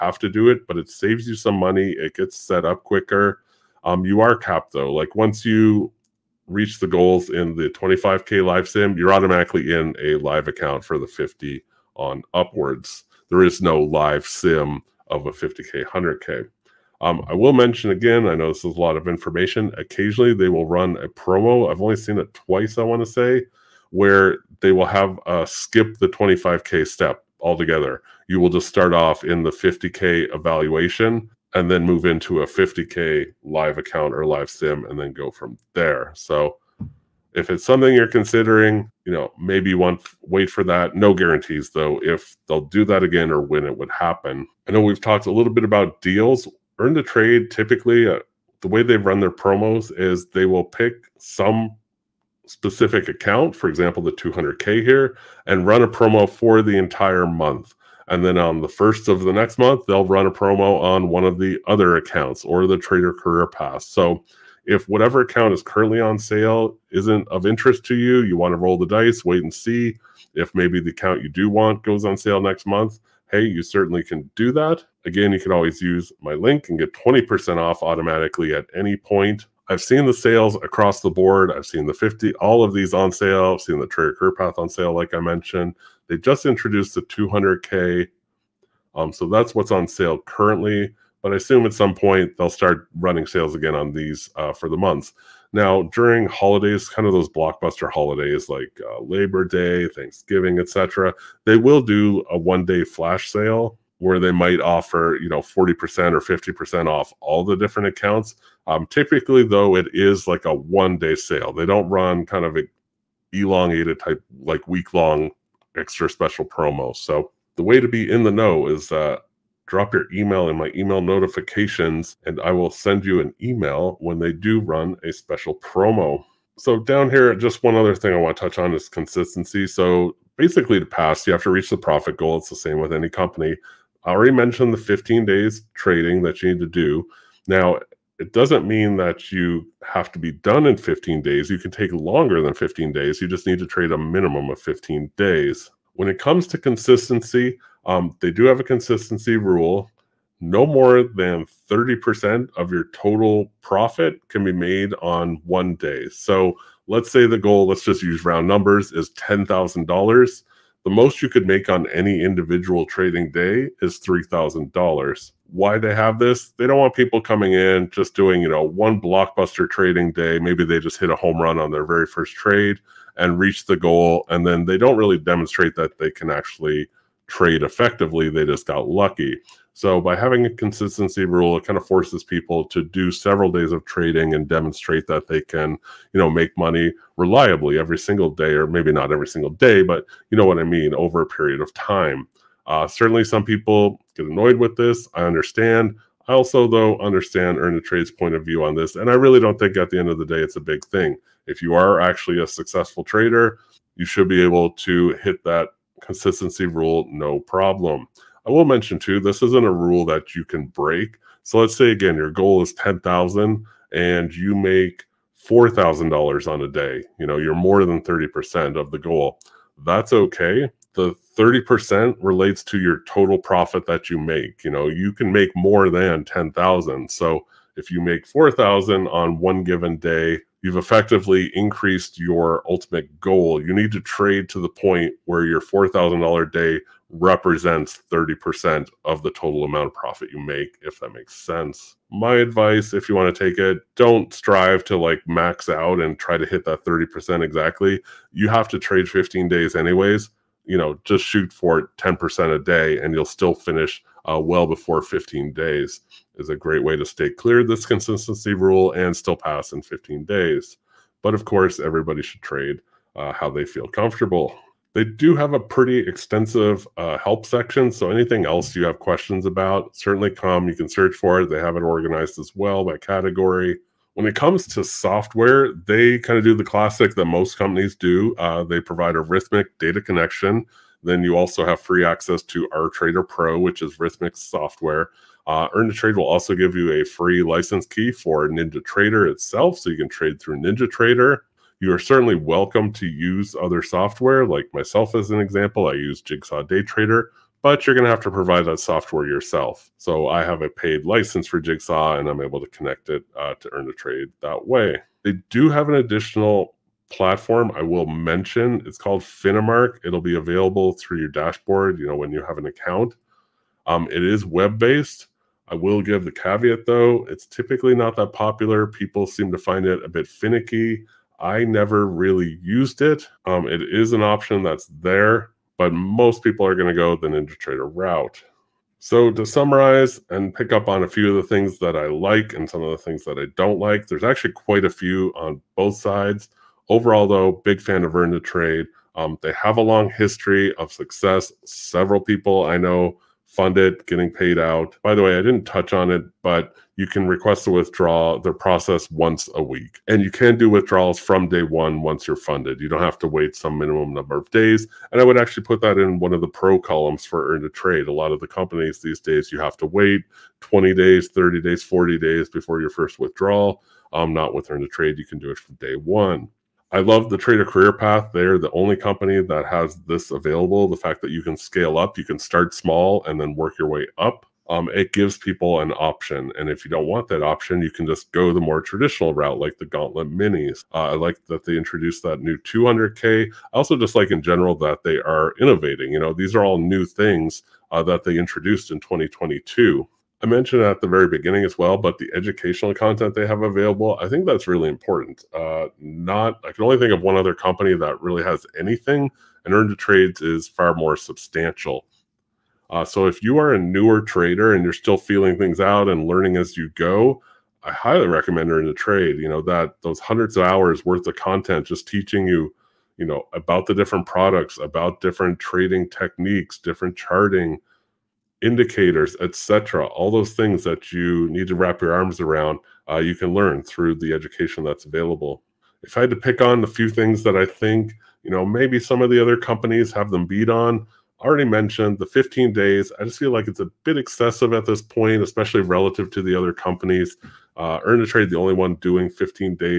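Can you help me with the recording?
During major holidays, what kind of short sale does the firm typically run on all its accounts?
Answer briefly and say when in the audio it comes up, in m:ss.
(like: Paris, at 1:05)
one-day flash sale, at 1:42.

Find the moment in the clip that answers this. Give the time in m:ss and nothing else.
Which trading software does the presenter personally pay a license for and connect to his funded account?
4:56.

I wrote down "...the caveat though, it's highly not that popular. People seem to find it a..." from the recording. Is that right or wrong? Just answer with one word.
wrong.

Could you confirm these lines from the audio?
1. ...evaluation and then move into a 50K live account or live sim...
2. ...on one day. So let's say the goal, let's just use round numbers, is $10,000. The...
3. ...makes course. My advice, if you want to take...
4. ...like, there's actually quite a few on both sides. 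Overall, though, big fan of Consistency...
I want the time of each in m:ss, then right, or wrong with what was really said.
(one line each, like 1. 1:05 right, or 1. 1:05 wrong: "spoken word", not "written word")
1. 0:30 right
2. 2:34 right
3. 4:01 wrong: "sense", not "course"
4. 5:33 wrong: "Earn", not "Consistency".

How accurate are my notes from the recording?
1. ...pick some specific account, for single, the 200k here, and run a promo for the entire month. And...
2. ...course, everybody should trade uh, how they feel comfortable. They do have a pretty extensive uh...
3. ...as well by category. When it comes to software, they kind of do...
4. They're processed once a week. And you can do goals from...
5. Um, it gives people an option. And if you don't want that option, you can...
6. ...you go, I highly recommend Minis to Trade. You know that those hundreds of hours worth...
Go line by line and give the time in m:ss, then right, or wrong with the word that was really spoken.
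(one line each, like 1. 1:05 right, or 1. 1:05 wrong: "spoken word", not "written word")
1. 0:50 wrong: "example", not "single"
2. 4:21 right
3. 4:32 right
4. 5:48 wrong: "withdrawals", not "goals"
5. 6:14 right
6. 6:46 wrong: "Earn", not "Minis".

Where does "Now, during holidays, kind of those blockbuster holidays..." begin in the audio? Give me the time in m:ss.
1:35.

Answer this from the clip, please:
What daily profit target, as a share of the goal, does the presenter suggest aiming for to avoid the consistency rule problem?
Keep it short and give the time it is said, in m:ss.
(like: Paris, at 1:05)
10%, at 4:11.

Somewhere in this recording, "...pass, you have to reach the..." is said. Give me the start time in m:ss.
2:10.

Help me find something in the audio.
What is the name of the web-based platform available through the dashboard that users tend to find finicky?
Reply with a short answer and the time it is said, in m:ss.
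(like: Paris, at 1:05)
Finamark, at 5:09.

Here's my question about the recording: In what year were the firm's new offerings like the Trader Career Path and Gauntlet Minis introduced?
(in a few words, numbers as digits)
2022.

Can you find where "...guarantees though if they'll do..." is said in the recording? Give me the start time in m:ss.
0:41.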